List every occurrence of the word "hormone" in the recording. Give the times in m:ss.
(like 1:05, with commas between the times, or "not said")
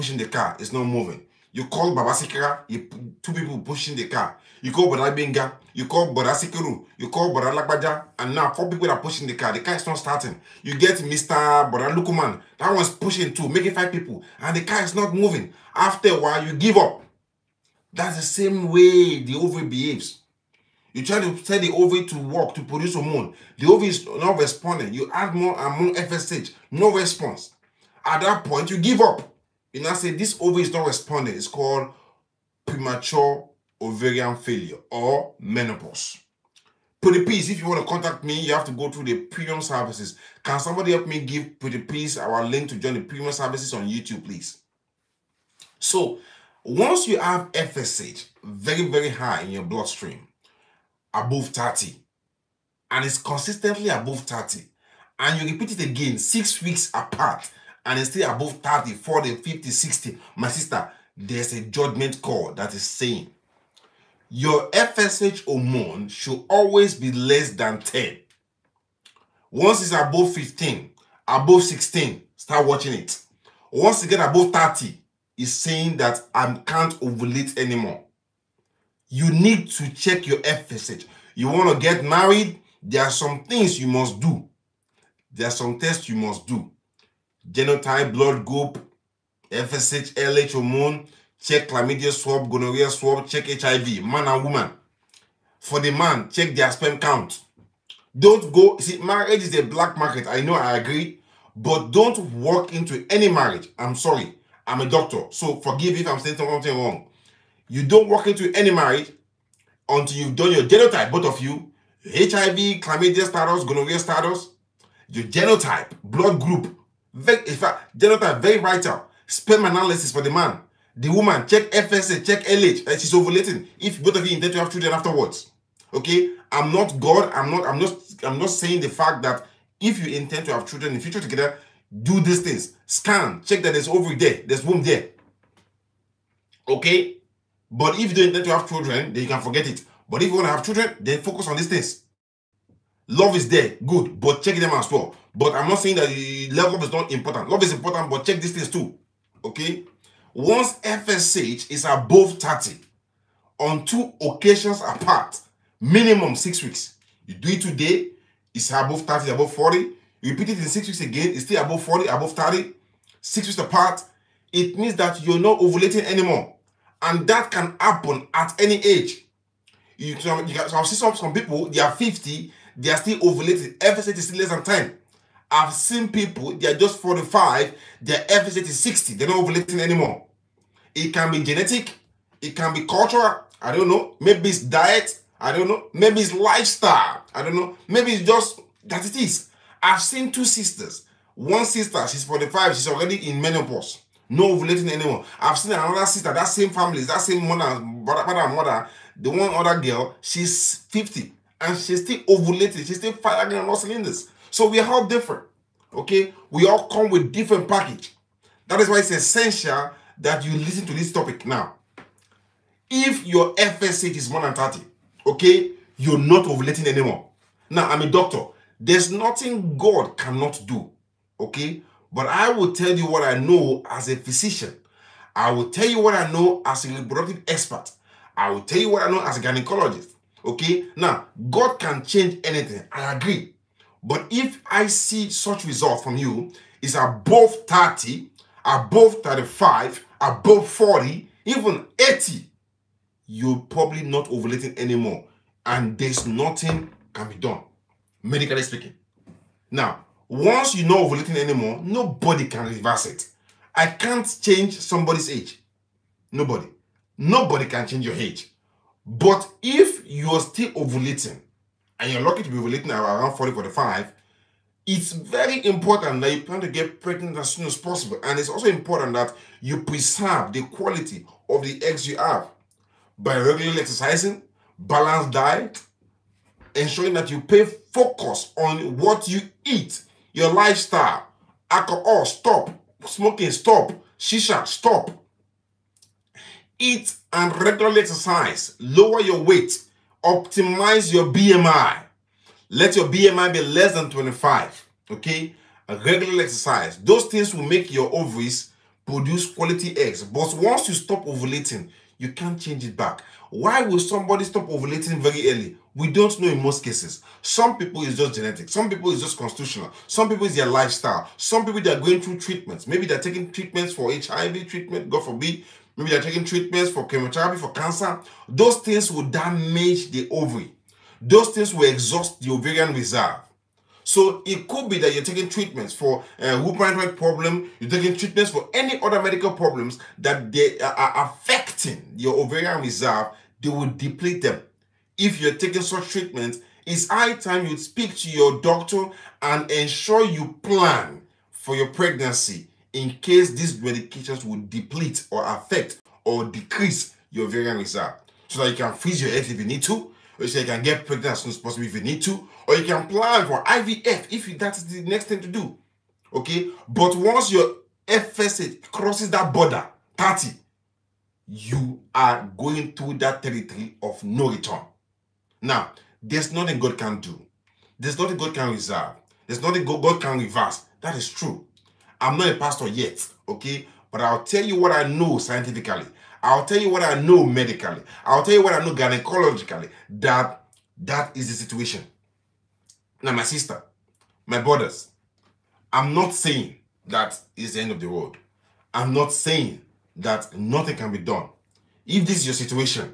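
0:22, 1:05, 1:30, 5:26.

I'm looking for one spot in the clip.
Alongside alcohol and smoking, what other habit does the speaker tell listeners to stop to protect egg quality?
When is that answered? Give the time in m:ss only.
4:44.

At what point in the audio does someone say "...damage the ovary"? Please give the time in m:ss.
5:19.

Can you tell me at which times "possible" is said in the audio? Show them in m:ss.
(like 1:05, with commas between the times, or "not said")
4:27, 5:51.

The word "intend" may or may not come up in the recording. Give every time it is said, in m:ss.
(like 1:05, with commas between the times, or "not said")
2:04, 2:10, 2:18.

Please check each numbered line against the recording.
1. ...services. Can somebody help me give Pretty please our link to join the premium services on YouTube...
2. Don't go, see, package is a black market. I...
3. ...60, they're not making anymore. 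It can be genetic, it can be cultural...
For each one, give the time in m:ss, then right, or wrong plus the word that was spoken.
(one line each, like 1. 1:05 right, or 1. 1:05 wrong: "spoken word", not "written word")
1. 0:39 right
2. 1:38 wrong: "marriage", not "package"
3. 2:58 wrong: "ovulating", not "making".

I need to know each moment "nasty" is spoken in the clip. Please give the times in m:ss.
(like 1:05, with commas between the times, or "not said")
not said.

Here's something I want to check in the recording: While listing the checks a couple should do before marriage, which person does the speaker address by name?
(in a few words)
Jonathan.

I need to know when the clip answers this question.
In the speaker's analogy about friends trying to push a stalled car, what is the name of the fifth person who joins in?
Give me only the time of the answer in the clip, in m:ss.
0:11.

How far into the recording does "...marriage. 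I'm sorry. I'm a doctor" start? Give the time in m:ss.
1:43.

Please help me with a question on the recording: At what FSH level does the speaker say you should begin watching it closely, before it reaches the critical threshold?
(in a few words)
above 15.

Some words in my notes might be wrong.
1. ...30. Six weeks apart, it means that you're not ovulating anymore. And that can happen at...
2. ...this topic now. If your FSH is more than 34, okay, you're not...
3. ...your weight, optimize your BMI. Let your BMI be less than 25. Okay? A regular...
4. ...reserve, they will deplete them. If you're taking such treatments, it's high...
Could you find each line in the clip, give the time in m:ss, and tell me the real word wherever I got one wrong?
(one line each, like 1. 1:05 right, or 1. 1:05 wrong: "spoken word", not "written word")
1. 2:42 right
2. 3:30 wrong: "30", not "34"
3. 4:49 right
4. 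5:32 right.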